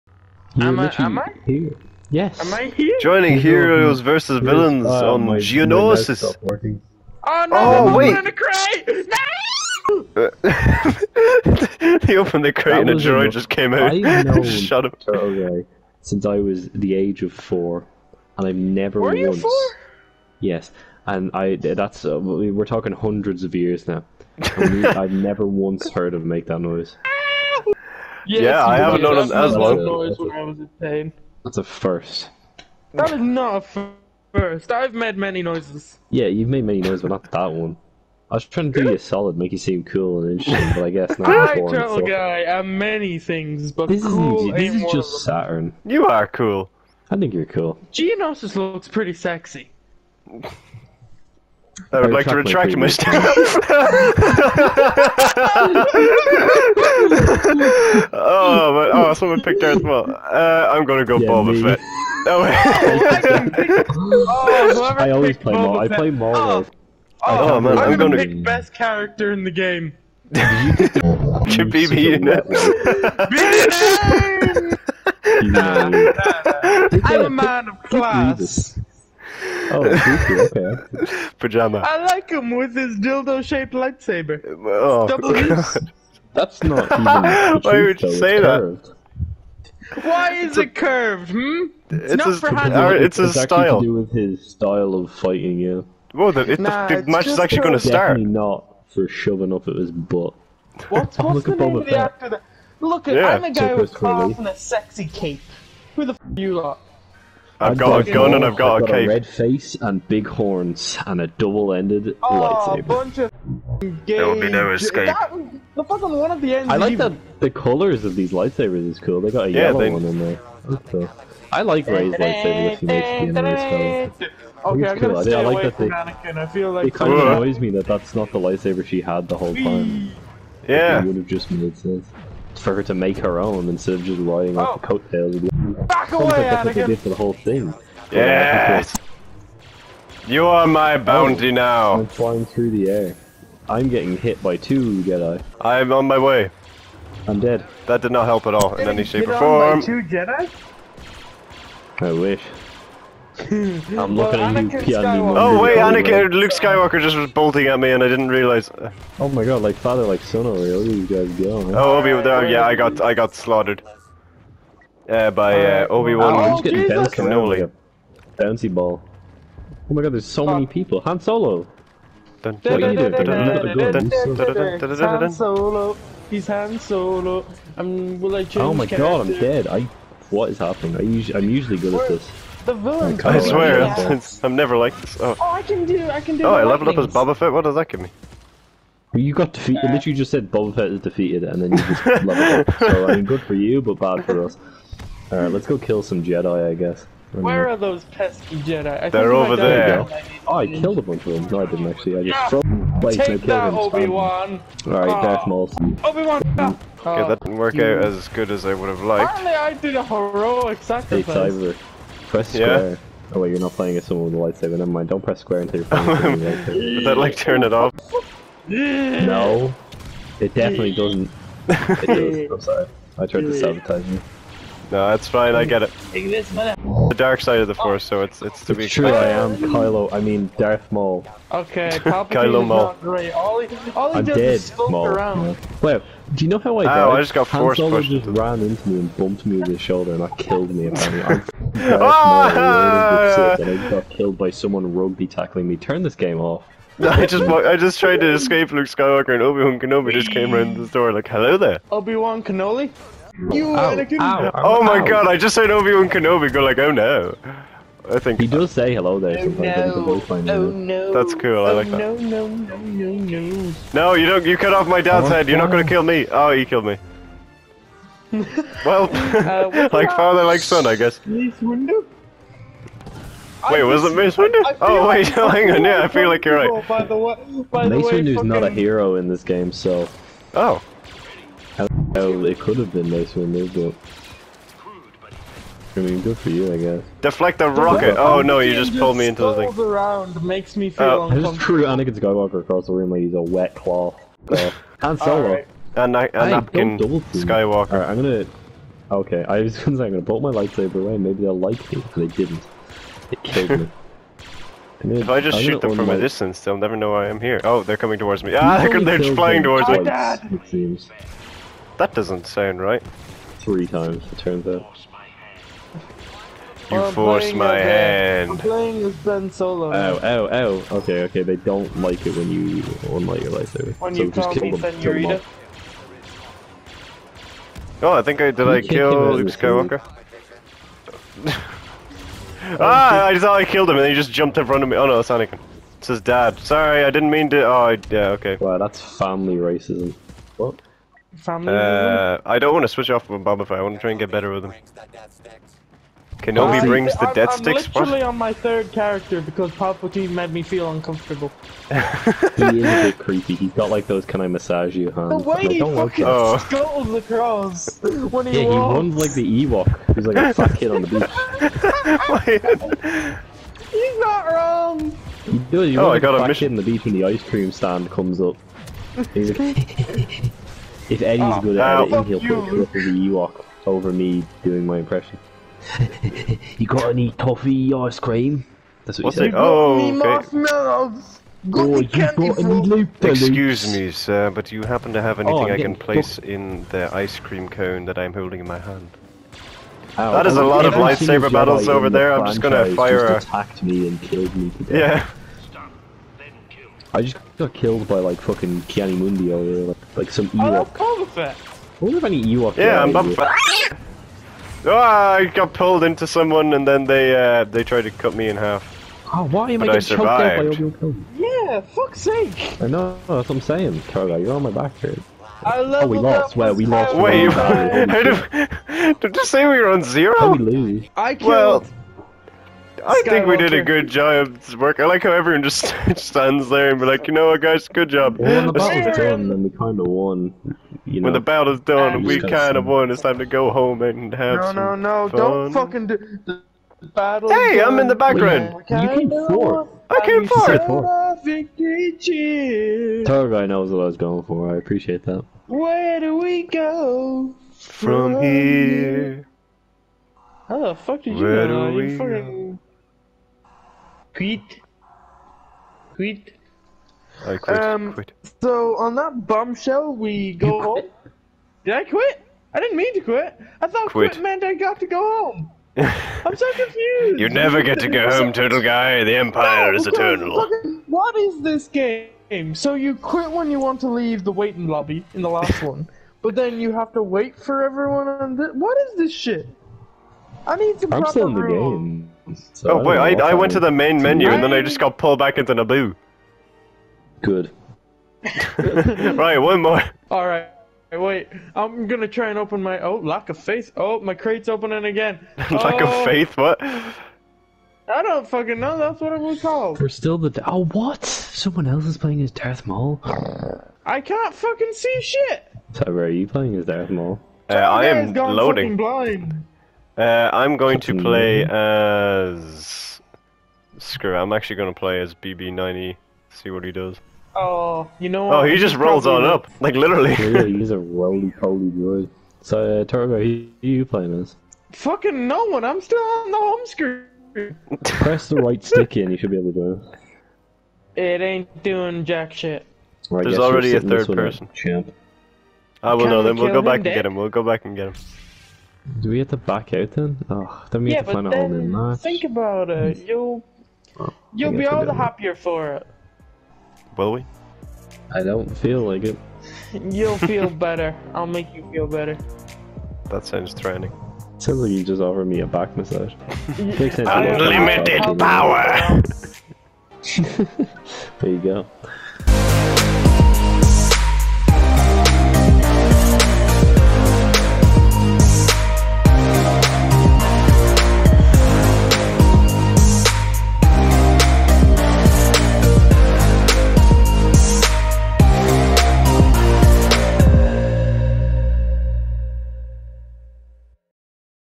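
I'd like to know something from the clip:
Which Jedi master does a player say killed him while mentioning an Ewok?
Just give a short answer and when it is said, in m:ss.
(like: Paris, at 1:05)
Ki-Adi-Mundi, at 6:38.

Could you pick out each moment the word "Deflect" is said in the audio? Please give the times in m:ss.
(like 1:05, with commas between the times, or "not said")
4:47.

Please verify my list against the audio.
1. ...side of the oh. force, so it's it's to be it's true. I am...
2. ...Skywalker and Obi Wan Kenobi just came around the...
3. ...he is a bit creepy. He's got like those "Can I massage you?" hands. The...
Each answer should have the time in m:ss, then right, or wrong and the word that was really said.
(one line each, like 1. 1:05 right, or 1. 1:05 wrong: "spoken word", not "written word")
1. 3:47 right
2. 4:08 right
3. 5:51 right.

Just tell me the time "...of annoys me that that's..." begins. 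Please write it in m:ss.
2:07.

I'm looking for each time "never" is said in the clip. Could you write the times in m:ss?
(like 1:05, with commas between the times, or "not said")
0:18, 0:25, 3:04, 3:34, 5:06, 7:47.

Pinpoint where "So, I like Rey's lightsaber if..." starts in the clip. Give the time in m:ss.
2:00.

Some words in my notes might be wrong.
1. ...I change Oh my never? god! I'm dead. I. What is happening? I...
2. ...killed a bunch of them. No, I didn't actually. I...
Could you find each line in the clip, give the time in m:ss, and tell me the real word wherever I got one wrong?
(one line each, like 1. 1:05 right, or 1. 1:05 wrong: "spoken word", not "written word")
1. 2:58 wrong: "character", not "never"
2. 3:20 right.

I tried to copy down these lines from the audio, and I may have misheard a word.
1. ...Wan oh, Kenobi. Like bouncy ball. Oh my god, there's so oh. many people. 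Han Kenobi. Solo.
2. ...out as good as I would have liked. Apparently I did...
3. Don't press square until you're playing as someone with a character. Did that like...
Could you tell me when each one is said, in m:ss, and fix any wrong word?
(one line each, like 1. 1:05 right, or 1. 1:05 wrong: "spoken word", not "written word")
1. 2:46 wrong: "Solo", not "Kenobi"
2. 3:27 right
3. 3:35 wrong: "lightsaber", not "character".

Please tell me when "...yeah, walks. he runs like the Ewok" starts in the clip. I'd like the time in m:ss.
5:58.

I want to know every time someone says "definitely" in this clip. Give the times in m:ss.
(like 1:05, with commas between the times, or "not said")
1:38, 3:40.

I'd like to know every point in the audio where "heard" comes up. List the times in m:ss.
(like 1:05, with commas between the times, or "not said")
0:25, 4:15.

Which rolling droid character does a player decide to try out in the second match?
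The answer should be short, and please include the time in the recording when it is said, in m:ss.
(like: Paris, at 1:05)
BB-9E, at 8:35.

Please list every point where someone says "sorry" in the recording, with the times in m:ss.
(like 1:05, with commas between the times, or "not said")
3:42, 5:36.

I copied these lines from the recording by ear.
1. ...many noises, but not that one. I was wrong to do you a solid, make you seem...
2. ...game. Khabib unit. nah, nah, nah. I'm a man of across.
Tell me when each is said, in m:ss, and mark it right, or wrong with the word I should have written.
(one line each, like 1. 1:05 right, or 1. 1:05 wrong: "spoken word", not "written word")
1. 0:36 wrong: "trying", not "wrong"
2. 1:09 wrong: "class", not "across".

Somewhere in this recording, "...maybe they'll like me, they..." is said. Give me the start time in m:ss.
5:01.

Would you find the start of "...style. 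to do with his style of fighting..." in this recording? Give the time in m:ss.
1:33.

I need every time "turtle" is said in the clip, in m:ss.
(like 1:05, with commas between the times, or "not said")
0:41, 7:48.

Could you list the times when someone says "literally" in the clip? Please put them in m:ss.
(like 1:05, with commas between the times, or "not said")
3:09, 5:48, 8:39.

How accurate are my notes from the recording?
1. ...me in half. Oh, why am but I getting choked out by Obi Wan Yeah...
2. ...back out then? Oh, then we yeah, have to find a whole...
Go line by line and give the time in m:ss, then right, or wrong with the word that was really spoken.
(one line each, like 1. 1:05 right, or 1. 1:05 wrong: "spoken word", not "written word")
1. 6:48 right
2. 8:59 right.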